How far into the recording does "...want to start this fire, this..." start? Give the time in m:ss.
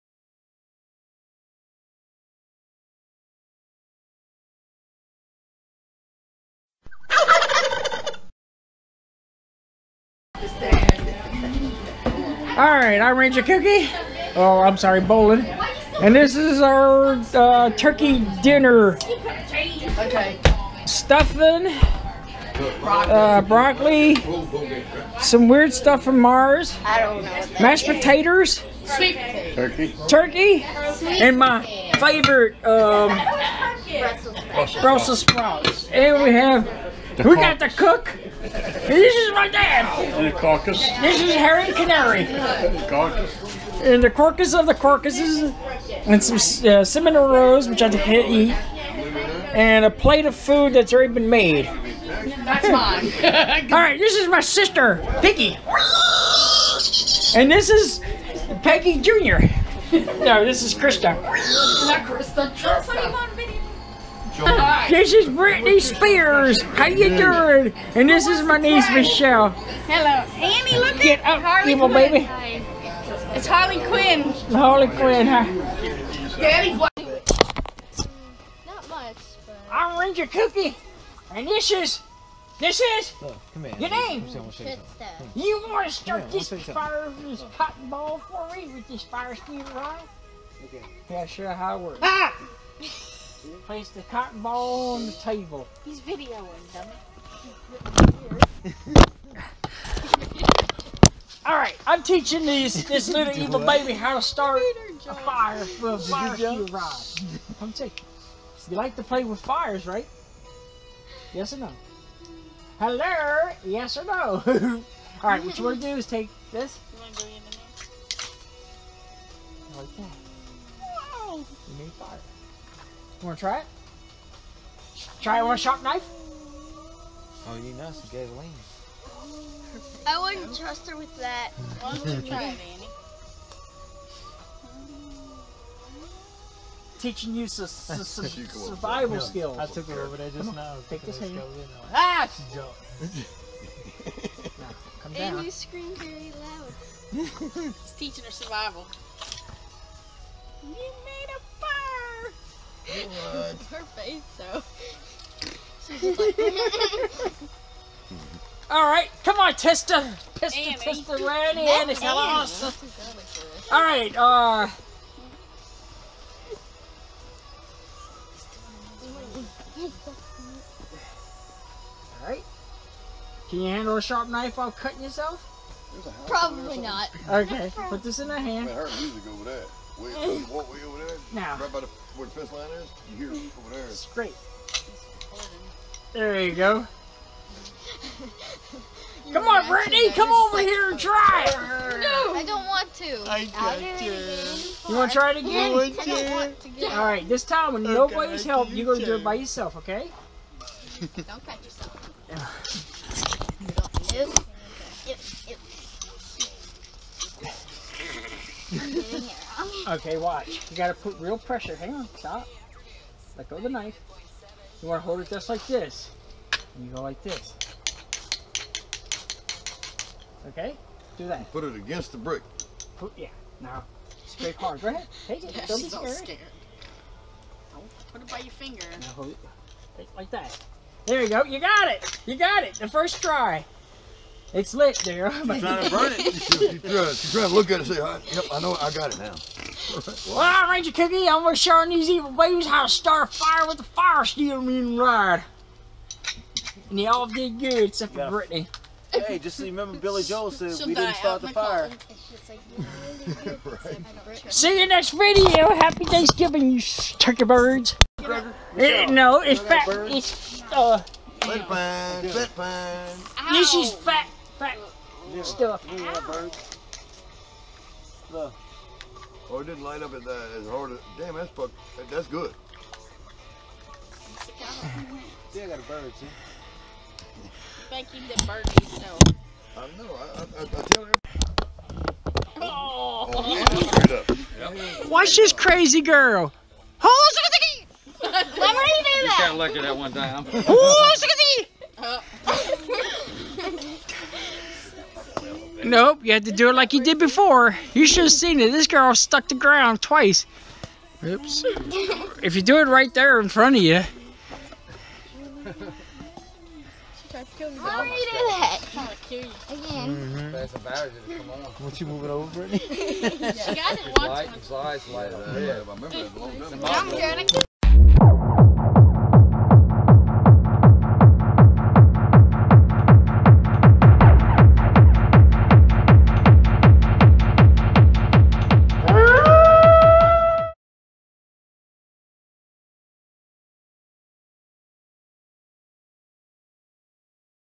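1:25.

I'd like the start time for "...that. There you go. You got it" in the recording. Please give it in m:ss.
3:50.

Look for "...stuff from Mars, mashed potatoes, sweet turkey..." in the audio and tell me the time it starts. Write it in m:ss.
0:25.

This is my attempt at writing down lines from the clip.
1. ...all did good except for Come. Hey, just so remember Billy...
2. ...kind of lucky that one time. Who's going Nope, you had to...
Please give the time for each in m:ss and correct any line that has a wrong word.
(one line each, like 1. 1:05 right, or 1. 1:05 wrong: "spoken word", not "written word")
1. 4:07 wrong: "Brittany", not "Come"
2. 4:49 right.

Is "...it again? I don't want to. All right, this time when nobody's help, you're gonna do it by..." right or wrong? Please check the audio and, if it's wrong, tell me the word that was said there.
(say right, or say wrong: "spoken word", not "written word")
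right.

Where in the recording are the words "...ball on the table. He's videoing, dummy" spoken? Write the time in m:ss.
1:34.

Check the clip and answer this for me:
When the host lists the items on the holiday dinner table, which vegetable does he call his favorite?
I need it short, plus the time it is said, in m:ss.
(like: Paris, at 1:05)
Brussels sprouts, at 0:34.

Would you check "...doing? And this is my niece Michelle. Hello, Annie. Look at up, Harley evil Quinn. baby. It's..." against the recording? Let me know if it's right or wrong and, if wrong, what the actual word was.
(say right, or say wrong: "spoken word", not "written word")
right.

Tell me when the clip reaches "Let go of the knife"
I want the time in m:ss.
3:33.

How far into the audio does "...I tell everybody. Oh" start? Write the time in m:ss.
4:40.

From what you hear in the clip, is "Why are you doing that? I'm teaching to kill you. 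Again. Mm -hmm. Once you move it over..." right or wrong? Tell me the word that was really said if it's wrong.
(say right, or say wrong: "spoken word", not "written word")
wrong: "trying", not "teaching".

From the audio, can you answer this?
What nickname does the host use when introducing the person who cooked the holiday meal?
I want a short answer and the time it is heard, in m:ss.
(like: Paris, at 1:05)
Harry Canary, at 0:41.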